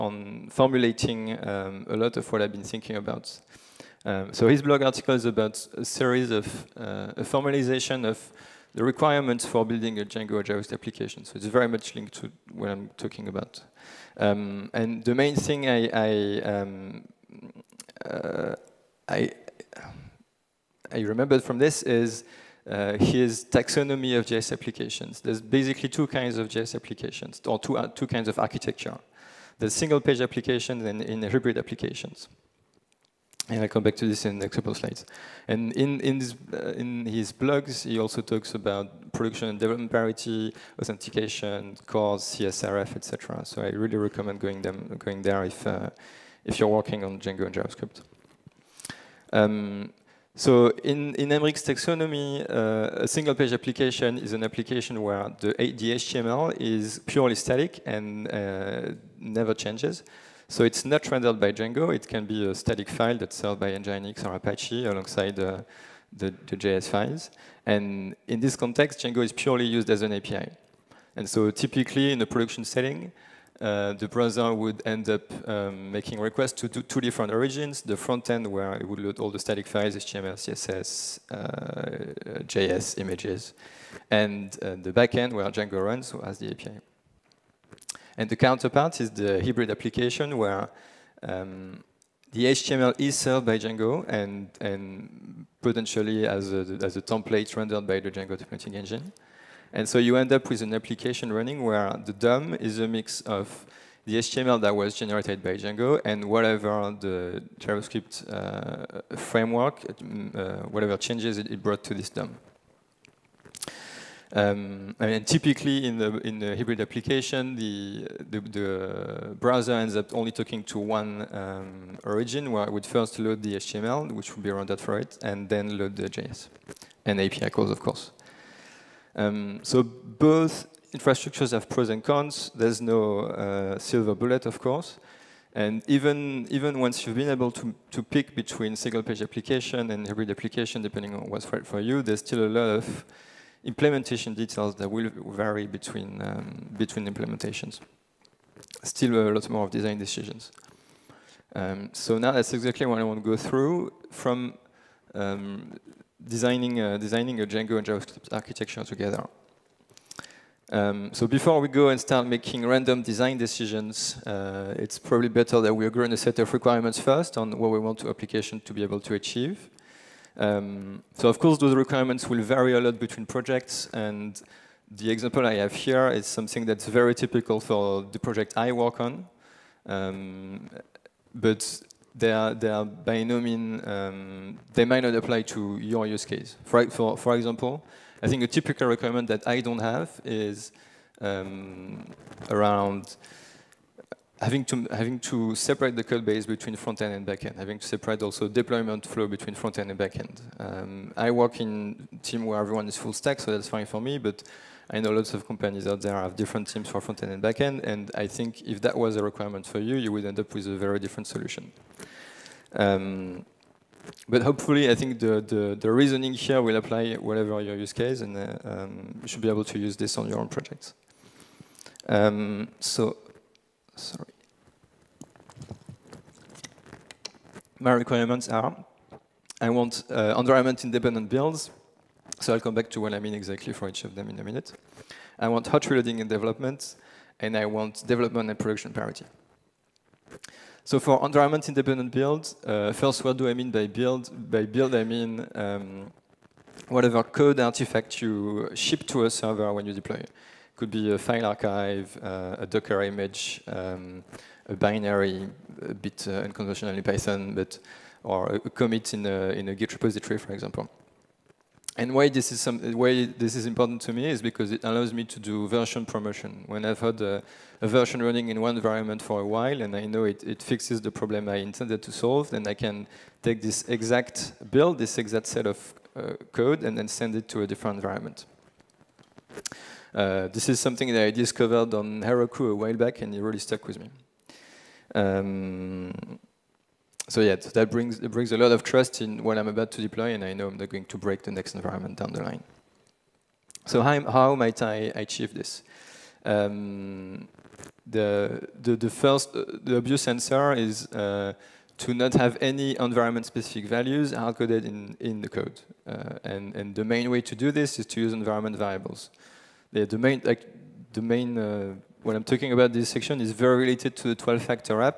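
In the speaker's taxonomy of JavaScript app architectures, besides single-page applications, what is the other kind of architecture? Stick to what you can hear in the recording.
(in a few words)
Hybrid applications.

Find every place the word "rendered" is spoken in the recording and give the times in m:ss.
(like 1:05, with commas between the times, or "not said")
1:01, 1:37, 2:04.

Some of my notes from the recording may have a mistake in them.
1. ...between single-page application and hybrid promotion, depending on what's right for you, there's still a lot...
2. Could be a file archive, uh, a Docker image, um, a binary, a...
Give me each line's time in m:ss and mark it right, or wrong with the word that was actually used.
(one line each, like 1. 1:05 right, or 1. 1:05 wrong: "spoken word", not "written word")
1. 2:18 wrong: "application", not "promotion"
2. 4:10 right.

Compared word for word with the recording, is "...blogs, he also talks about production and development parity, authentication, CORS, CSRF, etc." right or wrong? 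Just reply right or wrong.
right.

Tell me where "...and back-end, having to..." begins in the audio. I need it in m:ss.
3:17.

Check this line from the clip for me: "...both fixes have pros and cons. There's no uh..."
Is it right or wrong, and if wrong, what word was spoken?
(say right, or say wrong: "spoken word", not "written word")
wrong: "infrastructures", not "fixes".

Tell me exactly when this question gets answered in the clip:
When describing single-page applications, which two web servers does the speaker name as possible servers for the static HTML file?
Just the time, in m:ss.
1:03.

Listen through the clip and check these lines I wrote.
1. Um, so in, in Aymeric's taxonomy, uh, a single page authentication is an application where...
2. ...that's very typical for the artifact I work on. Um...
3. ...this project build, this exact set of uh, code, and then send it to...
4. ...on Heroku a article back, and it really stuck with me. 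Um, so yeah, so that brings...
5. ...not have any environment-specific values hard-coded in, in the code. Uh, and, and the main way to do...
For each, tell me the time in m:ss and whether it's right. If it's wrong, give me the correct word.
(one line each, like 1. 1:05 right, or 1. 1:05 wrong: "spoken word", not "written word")
1. 0:49 wrong: "application", not "authentication"
2. 2:56 wrong: "project", not "artifact"
3. 4:33 wrong: "exact", not "project"
4. 4:41 wrong: "while", not "article"
5. 5:02 right.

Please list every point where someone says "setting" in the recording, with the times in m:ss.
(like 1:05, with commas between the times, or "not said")
1:12.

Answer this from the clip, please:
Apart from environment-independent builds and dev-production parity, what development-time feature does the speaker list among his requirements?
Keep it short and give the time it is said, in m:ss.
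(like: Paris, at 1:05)
Hot reloading, at 3:55.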